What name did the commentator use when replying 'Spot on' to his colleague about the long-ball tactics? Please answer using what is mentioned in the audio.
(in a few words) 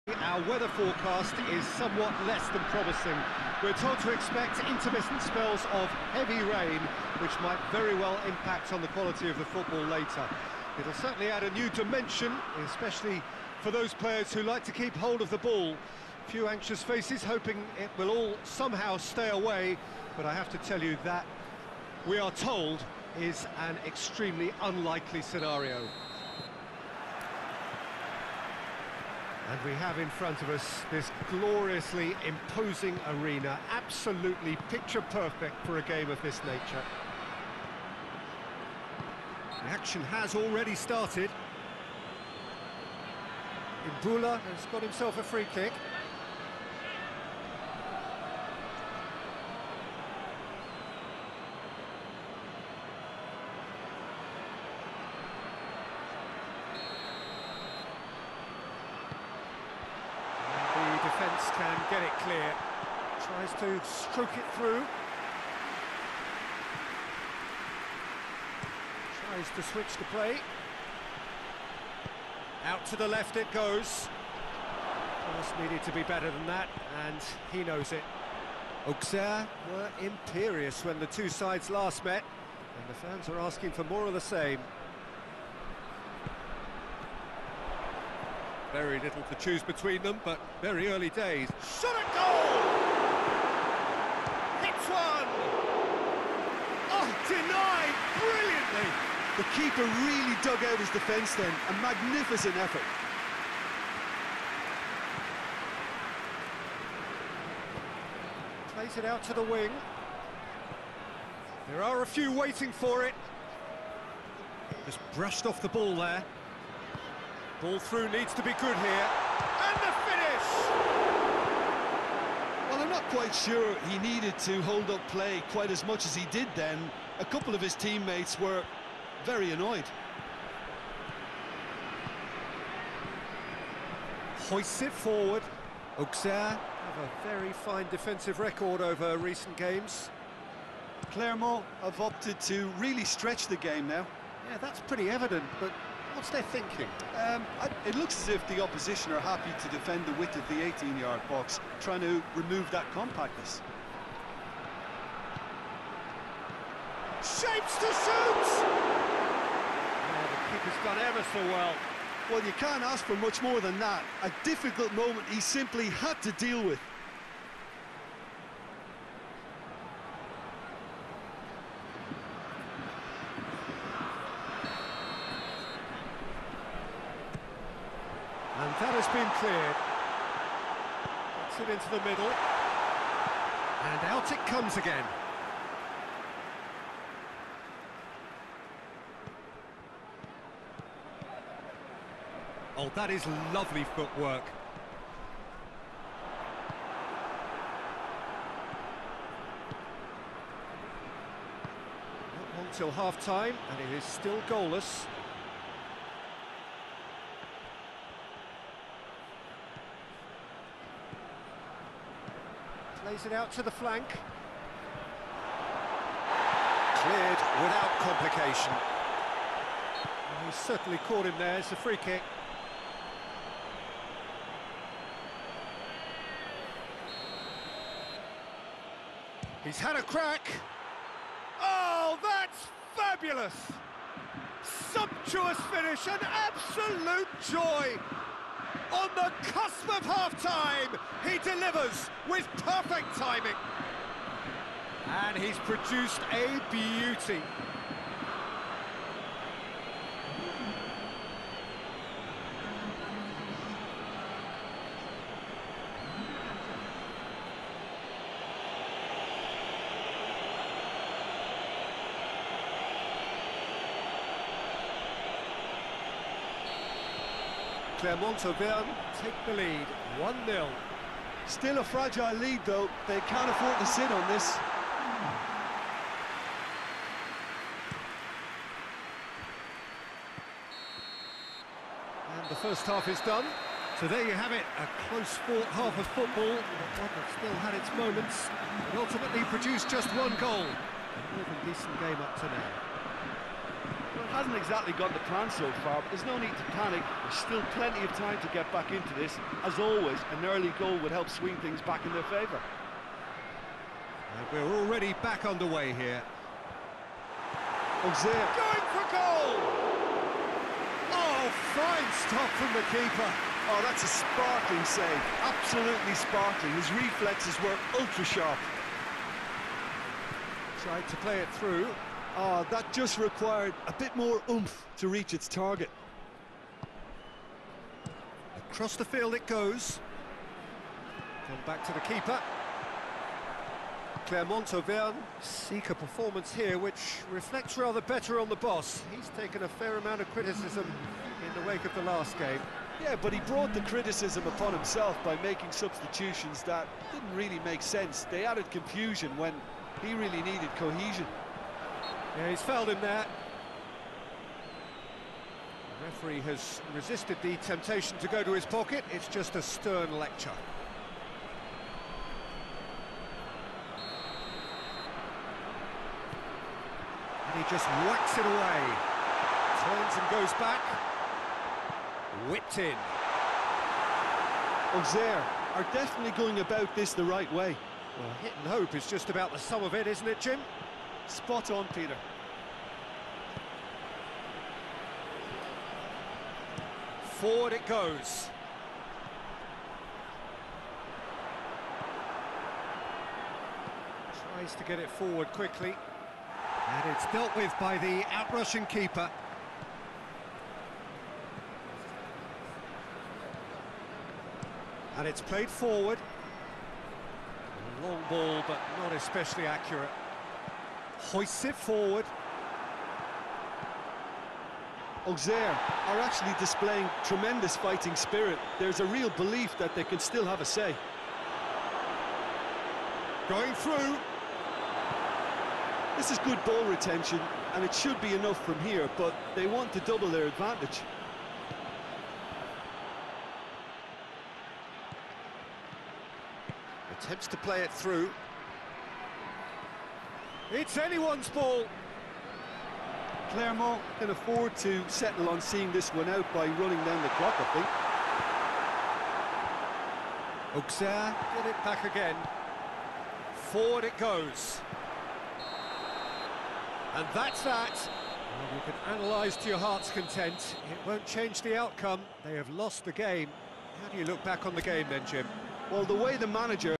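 Peter.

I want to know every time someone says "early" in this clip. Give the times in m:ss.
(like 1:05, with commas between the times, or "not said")
1:30, 5:00.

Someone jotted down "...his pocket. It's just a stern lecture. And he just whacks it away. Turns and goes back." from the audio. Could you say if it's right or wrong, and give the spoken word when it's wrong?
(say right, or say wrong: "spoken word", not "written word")
right.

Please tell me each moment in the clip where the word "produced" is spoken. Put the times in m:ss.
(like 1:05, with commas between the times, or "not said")
4:05, 4:49.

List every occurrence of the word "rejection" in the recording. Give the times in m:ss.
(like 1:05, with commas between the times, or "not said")
not said.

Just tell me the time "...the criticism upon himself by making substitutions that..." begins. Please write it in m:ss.
5:43.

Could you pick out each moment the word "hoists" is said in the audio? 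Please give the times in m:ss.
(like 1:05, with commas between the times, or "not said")
2:14, 6:51.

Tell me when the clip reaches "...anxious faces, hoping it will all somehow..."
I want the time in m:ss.
0:16.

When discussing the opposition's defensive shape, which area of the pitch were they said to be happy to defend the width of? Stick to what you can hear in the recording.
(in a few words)
18-yard box.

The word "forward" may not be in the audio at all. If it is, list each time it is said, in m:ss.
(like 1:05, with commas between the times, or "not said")
2:14, 6:27, 6:35, 6:45, 6:51, 7:33.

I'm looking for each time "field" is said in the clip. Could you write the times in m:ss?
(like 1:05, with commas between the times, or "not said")
5:29.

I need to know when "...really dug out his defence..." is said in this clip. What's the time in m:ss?
1:40.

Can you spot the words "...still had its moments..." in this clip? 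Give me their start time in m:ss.
4:47.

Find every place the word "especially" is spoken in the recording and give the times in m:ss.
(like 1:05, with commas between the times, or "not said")
0:12, 6:49.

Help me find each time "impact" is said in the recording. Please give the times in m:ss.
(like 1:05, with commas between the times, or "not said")
0:08.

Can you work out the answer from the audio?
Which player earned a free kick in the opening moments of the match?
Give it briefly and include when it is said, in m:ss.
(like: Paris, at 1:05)
Ibula, at 0:44.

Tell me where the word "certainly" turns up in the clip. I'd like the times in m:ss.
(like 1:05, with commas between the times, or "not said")
0:10, 3:40.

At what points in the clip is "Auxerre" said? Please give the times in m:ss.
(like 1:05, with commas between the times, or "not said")
1:18, 2:15, 5:08, 6:14, 6:55, 7:30.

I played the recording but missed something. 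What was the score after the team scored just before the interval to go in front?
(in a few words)
1-0.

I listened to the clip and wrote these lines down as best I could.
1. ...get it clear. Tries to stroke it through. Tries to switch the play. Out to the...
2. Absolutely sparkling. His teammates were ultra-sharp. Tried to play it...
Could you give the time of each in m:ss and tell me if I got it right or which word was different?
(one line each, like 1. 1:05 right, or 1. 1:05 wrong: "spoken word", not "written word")
1. 1:01 right
2. 5:15 wrong: "reflexes", not "teammates".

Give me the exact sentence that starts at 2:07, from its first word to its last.
A couple of his teammates were very annoyed.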